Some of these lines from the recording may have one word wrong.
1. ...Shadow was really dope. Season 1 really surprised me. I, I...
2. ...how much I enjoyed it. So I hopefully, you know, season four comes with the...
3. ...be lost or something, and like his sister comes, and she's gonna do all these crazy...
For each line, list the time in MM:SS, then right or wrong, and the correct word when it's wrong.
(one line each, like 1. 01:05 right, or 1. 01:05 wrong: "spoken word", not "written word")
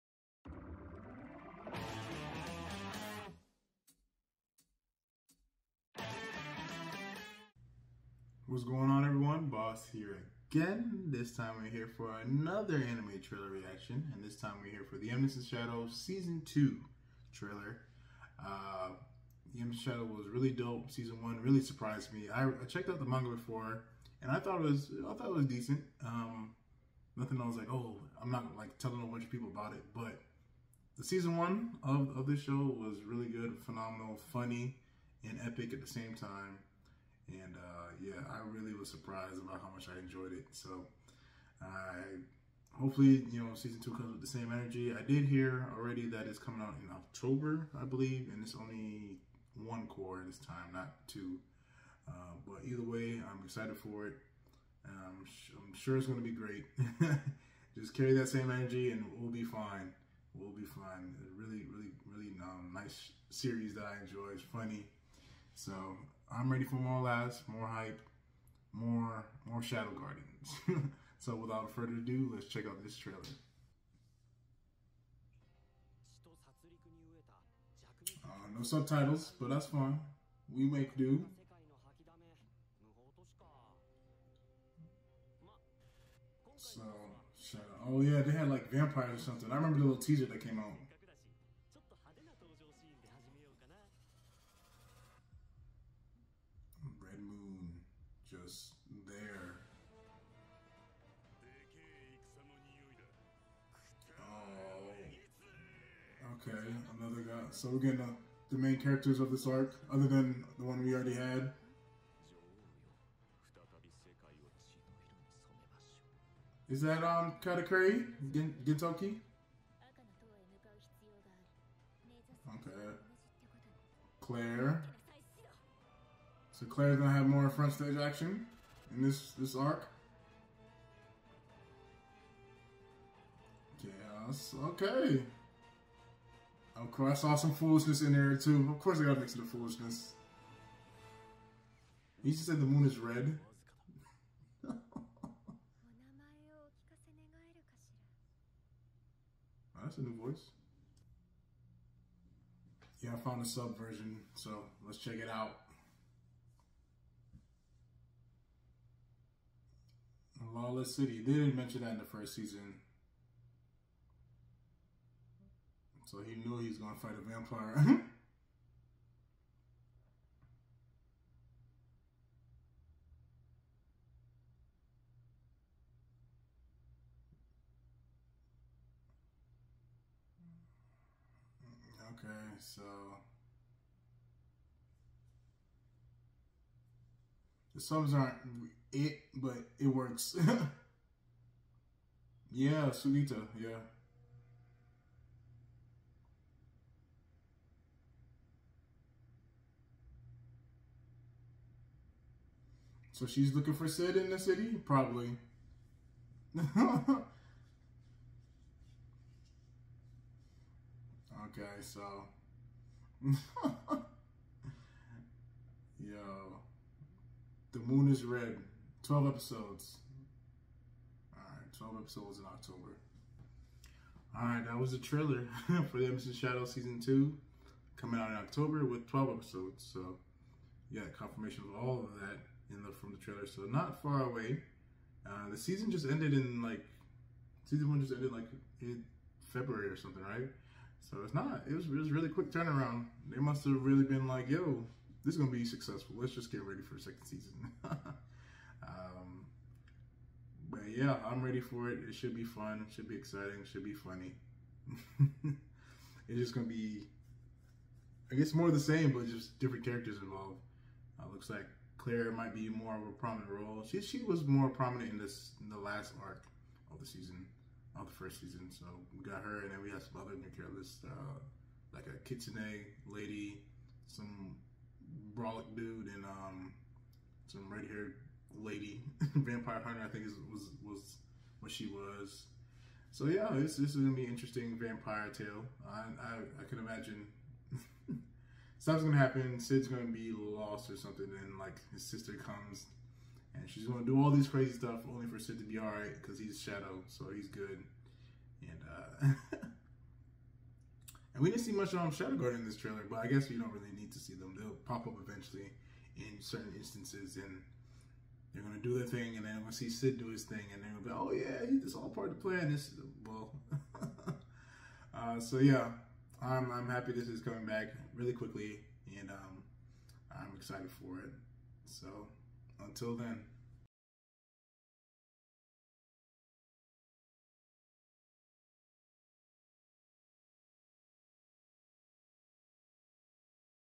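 1. 00:19 right
2. 00:39 wrong: "two", not "four"
3. 04:50 right.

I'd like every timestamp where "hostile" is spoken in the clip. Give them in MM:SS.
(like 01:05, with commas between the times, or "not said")
not said.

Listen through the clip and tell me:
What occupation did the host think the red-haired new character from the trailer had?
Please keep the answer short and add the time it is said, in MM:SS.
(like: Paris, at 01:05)
vampire hunter, at 04:39.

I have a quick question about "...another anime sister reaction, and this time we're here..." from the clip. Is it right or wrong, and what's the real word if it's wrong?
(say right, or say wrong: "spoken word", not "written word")
wrong: "trailer", not "sister".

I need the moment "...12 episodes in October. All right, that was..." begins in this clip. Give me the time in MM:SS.
03:41.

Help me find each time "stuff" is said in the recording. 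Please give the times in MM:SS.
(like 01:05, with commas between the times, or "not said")
04:48, 04:54.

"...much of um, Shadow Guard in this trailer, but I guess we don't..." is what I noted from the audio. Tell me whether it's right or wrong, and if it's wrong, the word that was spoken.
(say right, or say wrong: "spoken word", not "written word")
right.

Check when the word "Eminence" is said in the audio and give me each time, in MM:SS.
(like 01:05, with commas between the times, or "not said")
00:15, 00:19, 03:46.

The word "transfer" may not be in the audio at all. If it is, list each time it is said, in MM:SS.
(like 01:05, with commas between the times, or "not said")
not said.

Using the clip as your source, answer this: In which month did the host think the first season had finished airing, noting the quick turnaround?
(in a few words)
February.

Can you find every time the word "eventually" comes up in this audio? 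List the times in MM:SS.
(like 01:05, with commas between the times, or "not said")
05:05.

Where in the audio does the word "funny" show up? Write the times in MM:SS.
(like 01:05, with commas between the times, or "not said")
00:34, 01:04, 04:13.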